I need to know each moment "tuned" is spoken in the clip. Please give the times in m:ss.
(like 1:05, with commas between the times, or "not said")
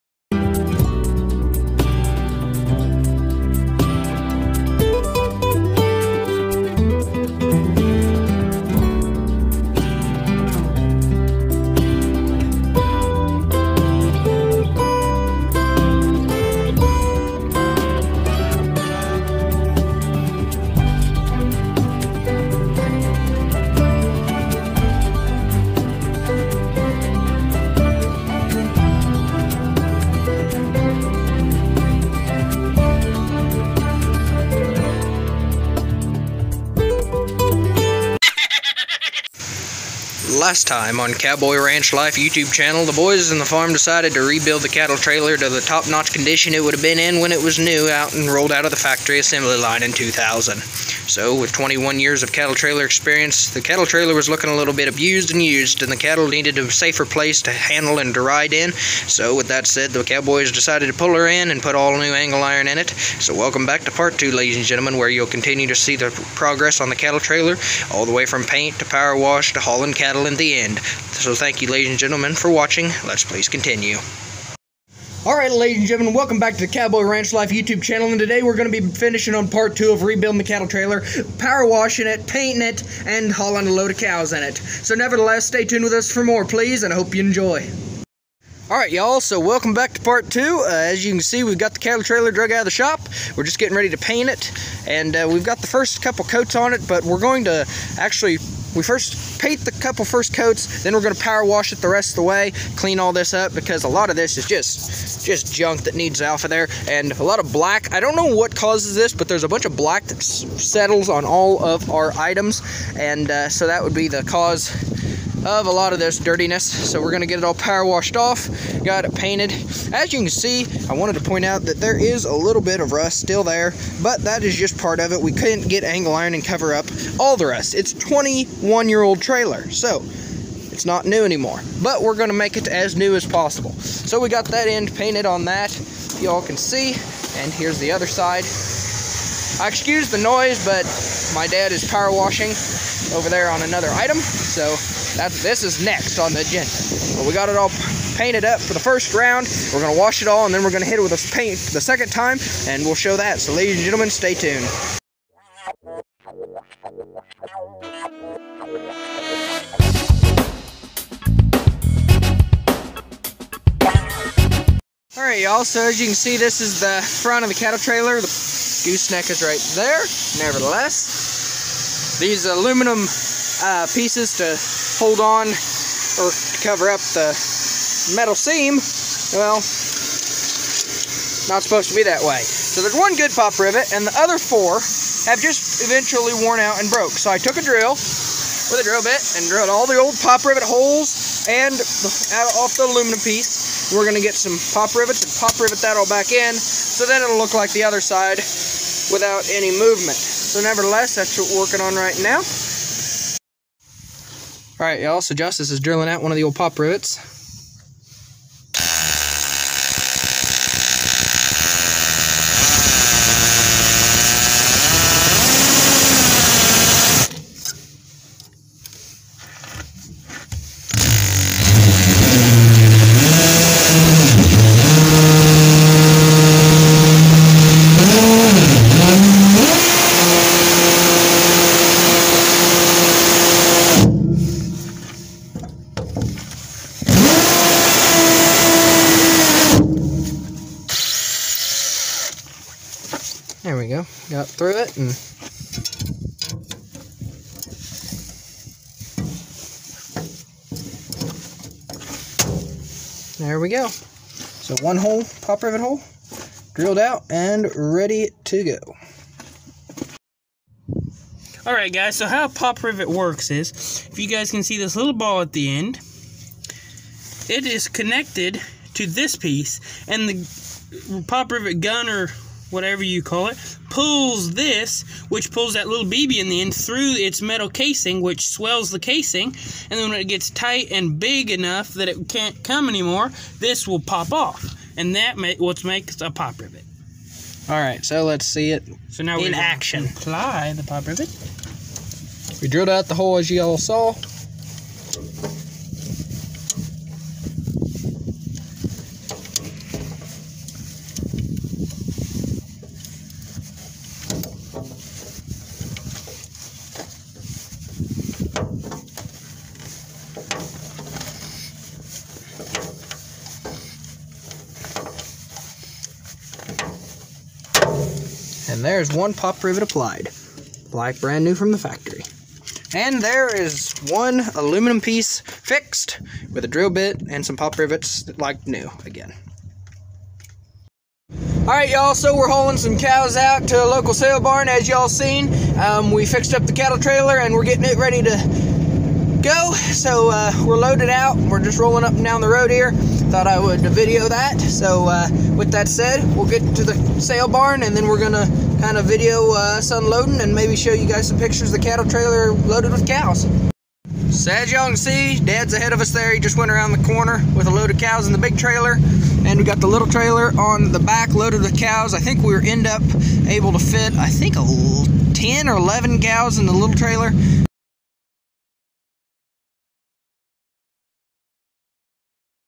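1:25, 2:34.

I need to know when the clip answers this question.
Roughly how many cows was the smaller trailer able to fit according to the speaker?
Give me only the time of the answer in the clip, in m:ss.
6:04.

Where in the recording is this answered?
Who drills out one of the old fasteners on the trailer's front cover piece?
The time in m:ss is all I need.
3:25.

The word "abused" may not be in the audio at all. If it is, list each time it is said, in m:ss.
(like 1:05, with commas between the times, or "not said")
0:54.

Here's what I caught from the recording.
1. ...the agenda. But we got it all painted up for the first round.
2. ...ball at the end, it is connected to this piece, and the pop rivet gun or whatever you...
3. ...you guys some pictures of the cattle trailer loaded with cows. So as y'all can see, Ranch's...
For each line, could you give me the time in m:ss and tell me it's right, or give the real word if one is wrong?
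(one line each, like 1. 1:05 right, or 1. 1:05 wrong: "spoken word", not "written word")
1. 2:26 right
2. 4:25 right
3. 5:50 wrong: "Dad", not "Ranch".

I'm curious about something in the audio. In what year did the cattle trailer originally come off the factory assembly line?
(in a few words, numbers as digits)
2000.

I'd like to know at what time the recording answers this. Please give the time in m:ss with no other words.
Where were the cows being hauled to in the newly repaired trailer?
5:33.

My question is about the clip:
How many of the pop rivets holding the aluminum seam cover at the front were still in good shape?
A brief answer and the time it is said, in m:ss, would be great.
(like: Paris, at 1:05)
1, at 3:02.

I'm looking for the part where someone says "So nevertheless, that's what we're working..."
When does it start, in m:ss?
3:20.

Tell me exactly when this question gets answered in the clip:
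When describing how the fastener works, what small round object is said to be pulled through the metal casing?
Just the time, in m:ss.
4:36.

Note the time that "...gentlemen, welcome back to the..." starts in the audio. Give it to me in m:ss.
1:15.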